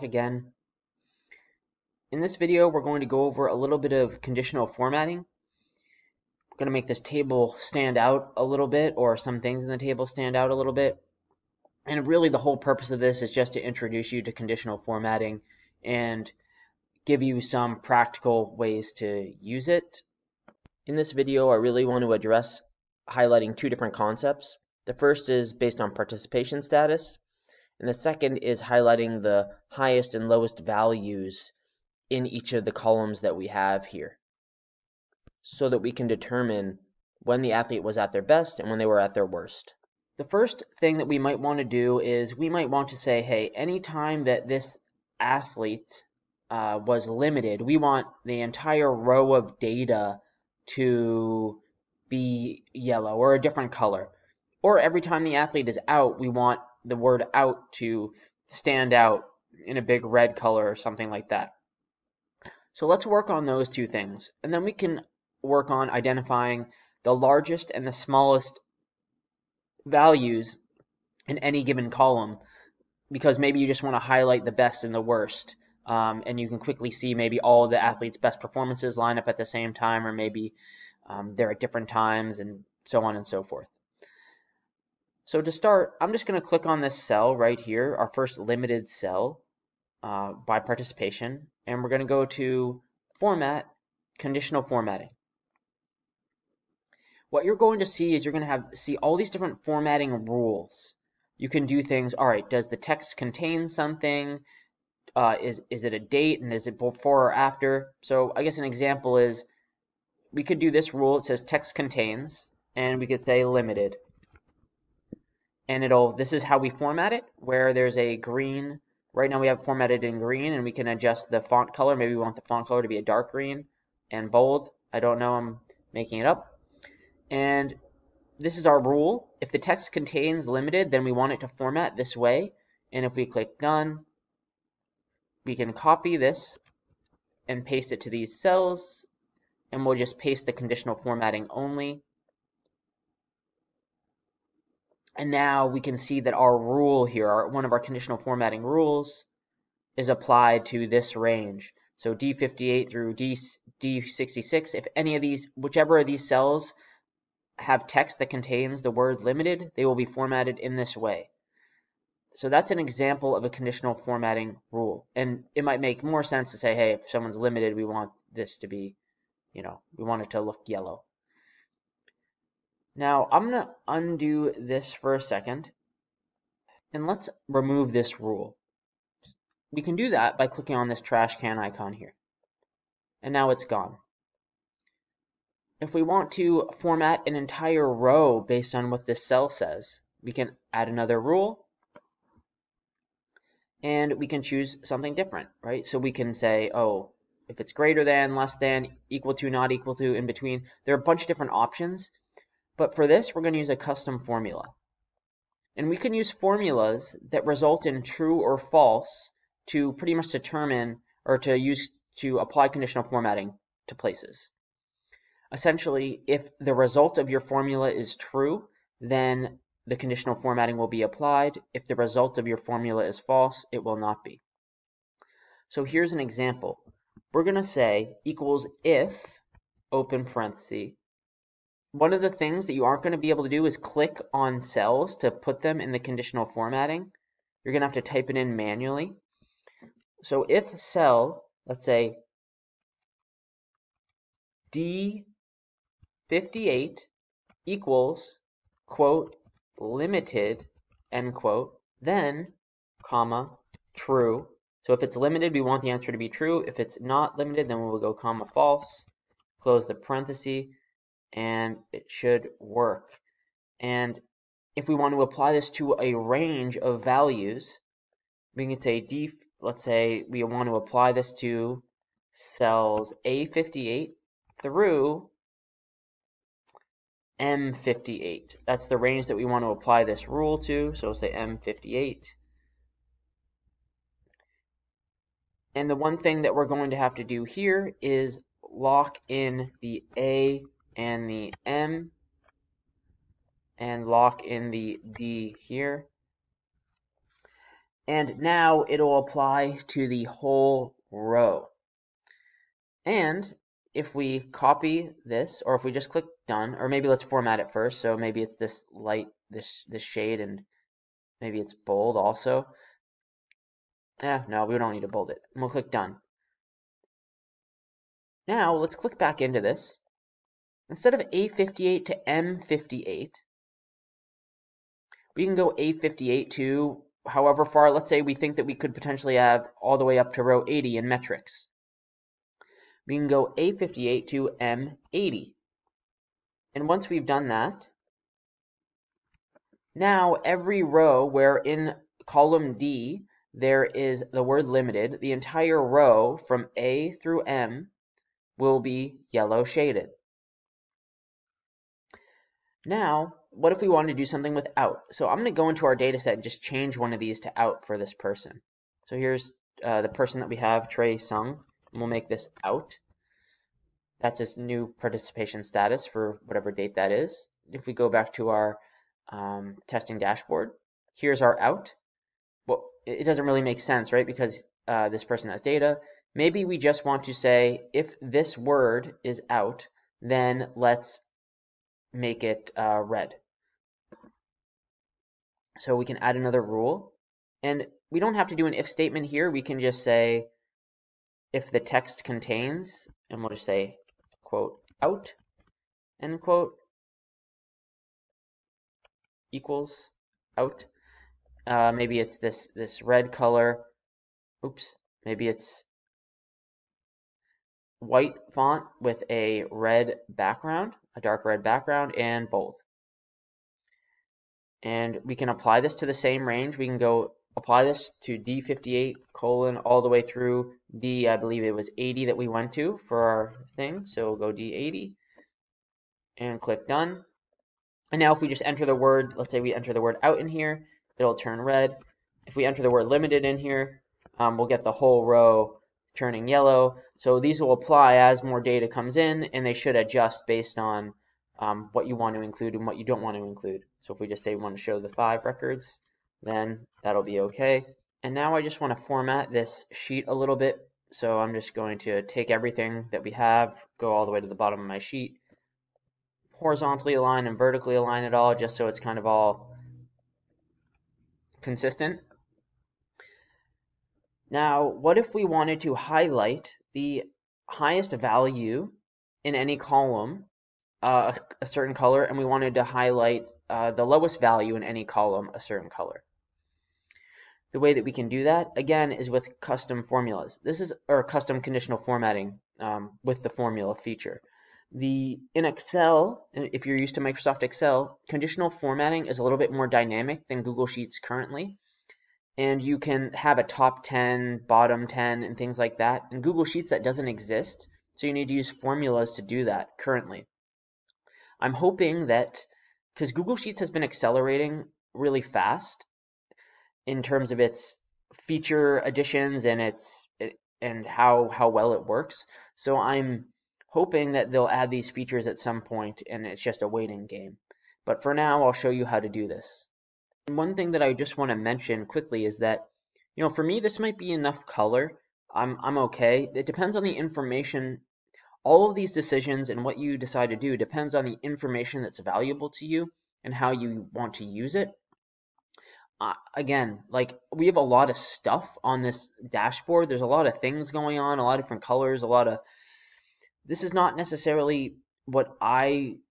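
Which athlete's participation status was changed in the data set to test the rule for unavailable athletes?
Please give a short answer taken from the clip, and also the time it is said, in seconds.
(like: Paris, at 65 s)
Trey Sung, at 360 s.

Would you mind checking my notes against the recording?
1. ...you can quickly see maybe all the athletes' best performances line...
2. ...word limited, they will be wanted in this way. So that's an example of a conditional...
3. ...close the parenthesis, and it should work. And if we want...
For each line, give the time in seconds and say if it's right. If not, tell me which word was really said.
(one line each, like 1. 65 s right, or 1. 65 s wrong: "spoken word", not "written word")
1. 76 s right
2. 158 s wrong: "formatted", not "wanted"
3. 259 s right.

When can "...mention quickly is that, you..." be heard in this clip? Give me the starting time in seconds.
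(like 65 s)
521 s.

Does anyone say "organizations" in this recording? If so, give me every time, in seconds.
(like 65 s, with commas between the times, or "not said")
not said.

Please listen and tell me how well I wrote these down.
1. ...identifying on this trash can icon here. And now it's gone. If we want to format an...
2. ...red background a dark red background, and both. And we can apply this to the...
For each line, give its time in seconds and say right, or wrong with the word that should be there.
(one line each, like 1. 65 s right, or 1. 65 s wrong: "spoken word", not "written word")
1. 180 s wrong: "clicking", not "identifying"
2. 409 s right.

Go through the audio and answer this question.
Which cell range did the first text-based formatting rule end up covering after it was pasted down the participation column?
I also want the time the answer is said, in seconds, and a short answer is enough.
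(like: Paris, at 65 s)
D58 through D66, at 152 s.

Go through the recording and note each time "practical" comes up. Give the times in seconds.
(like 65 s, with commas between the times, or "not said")
17 s.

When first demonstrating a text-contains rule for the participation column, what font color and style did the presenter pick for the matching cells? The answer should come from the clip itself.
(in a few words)
Dark green and bold.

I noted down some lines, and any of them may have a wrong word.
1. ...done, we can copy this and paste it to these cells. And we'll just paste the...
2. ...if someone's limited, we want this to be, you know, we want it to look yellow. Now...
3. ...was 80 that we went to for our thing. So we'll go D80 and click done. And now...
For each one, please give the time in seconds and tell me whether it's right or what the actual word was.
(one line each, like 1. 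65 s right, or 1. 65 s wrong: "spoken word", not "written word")
1. 133 s right
2. 166 s right
3. 421 s right.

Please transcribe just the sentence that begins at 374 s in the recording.
Because uh, this person has data.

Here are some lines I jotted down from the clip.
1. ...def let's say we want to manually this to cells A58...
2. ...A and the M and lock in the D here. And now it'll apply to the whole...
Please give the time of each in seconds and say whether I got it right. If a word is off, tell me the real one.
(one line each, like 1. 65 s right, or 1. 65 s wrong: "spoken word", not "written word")
1. 269 s wrong: "apply", not "manually"
2. 290 s right.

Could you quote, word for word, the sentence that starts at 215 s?
Essentially, if the result of your formula is true, then the conditional formatting will be applied.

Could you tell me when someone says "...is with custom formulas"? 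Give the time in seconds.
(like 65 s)
479 s.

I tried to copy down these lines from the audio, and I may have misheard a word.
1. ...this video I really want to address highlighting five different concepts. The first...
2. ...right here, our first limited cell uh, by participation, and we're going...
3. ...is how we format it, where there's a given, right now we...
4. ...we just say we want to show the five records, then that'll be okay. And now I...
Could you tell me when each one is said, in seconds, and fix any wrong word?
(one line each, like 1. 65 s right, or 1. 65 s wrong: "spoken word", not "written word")
1. 20 s wrong: "two", not "five"
2. 87 s right
3. 116 s wrong: "green", not "given"
4. 444 s right.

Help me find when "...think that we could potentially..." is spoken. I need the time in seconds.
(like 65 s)
328 s.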